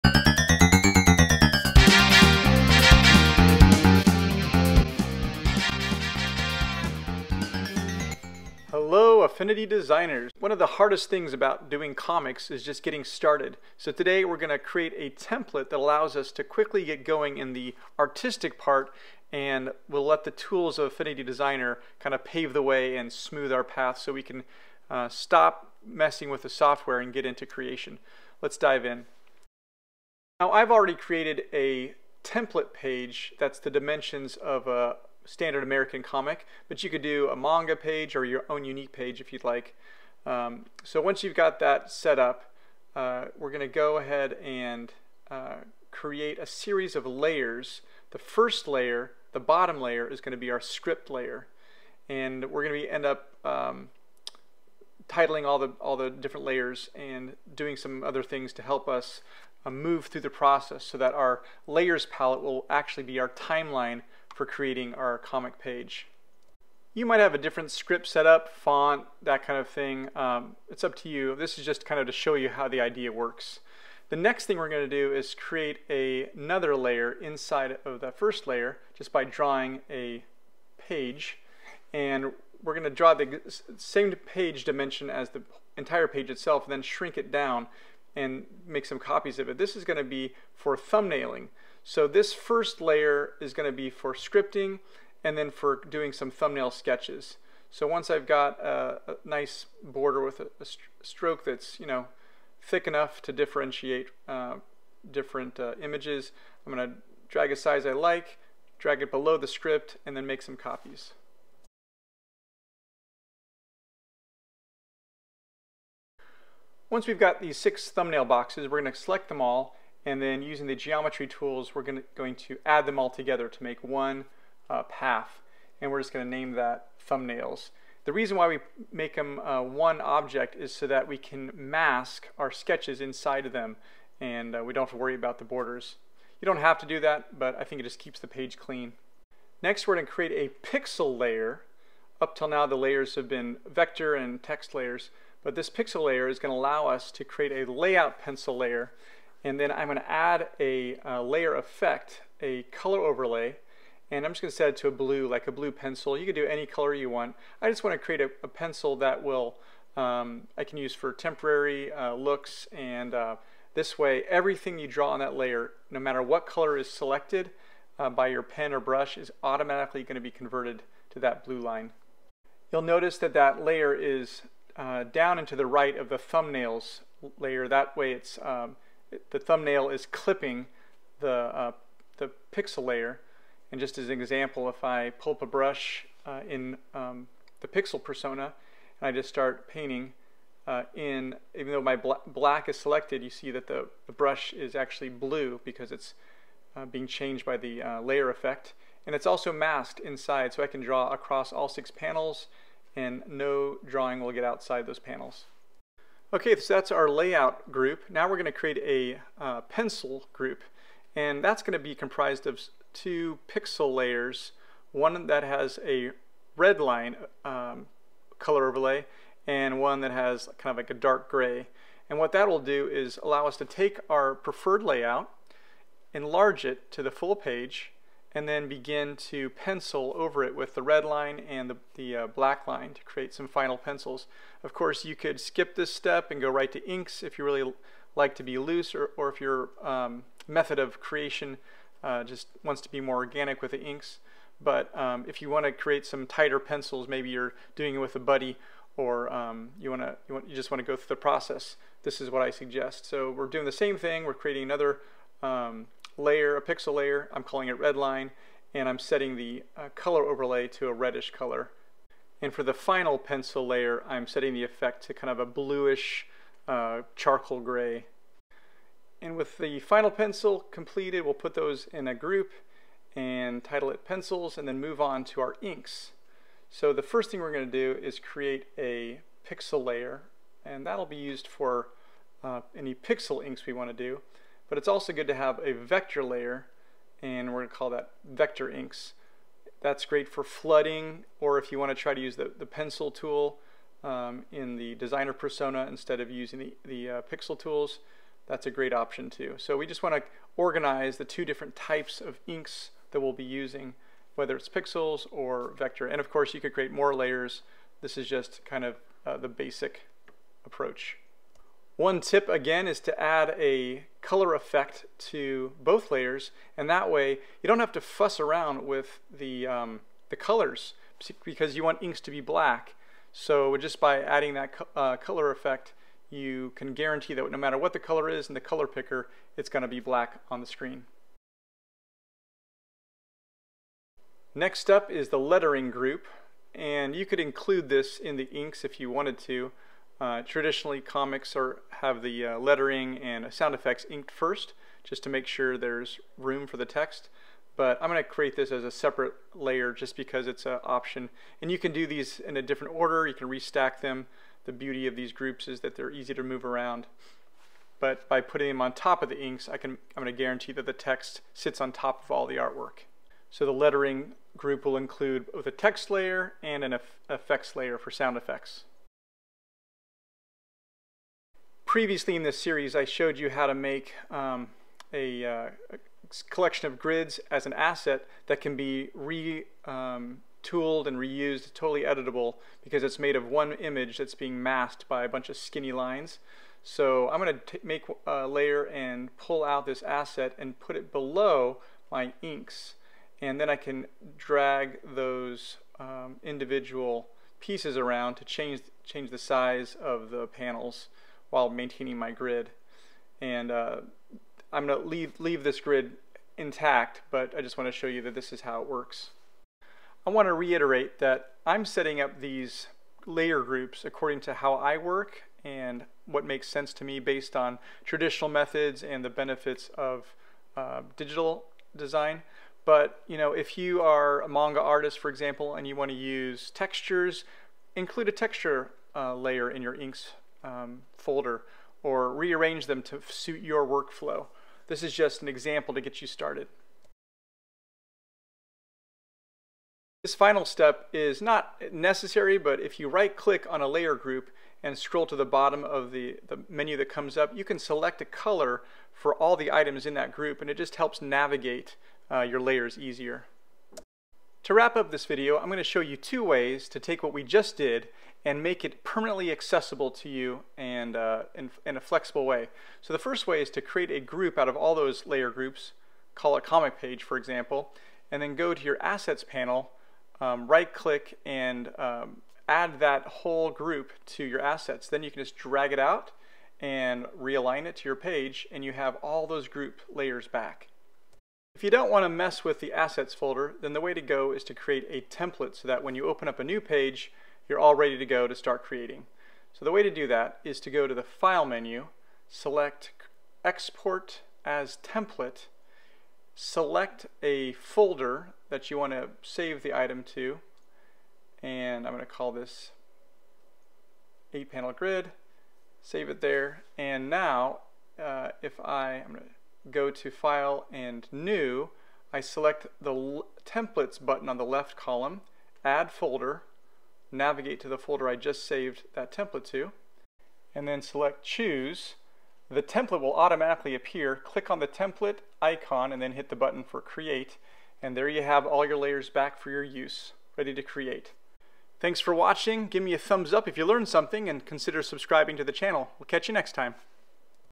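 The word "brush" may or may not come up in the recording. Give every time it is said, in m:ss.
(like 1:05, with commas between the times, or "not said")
2:48, 3:05, 3:14.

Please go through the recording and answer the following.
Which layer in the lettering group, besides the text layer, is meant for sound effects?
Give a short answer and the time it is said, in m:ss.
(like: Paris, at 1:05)
effects layer, at 6:07.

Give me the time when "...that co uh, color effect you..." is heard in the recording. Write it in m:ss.
5:24.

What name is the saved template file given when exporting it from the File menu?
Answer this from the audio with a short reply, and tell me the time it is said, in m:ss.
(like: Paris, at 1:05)
8-panel grid, at 8:24.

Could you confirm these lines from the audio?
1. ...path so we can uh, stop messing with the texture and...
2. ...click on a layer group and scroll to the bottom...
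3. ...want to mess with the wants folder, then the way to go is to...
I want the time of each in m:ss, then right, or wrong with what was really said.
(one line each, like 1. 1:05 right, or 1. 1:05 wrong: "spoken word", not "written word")
1. 0:23 wrong: "software", not "texture"
2. 7:23 right
3. 8:02 wrong: "assets", not "wants".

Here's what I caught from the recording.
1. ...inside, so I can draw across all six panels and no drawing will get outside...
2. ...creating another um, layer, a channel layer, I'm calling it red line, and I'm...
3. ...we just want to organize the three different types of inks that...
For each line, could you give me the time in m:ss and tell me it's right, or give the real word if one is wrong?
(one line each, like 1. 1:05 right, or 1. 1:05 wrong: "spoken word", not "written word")
1. 3:19 right
2. 4:14 wrong: "pixel", not "channel"
3. 4:59 wrong: "two", not "three".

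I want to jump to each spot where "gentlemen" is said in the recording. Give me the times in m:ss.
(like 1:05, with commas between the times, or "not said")
not said.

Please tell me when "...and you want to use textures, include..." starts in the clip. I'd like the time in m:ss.
7:05.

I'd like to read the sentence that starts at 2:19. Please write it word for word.
Next, we're going to create a pixel layer.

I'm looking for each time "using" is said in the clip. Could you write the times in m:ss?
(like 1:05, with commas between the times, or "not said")
2:00, 4:56, 5:03.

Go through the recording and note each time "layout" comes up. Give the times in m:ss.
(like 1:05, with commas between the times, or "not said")
2:27, 3:27, 3:44.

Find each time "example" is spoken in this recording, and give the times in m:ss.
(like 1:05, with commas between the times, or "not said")
3:04, 7:05, 7:15, 7:47.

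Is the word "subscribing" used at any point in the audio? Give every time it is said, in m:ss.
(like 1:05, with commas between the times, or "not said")
8:55.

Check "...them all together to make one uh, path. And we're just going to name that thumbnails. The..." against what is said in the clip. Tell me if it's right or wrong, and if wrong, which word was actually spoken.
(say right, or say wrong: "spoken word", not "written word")
right.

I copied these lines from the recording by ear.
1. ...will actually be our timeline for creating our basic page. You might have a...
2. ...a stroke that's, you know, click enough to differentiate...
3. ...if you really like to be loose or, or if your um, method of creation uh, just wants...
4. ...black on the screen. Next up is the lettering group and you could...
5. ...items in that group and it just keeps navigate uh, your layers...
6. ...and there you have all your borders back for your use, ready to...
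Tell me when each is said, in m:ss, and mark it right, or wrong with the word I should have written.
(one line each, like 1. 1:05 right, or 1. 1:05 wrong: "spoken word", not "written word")
1. 1:02 wrong: "comic", not "basic"
2. 1:40 wrong: "thick", not "click"
3. 3:57 right
4. 5:29 right
5. 7:29 wrong: "helps", not "keeps"
6. 8:48 wrong: "layers", not "borders".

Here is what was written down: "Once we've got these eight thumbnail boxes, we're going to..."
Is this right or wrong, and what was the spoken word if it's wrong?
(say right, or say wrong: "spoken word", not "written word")
wrong: "six", not "eight".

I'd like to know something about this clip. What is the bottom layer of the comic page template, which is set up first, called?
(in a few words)
script layer.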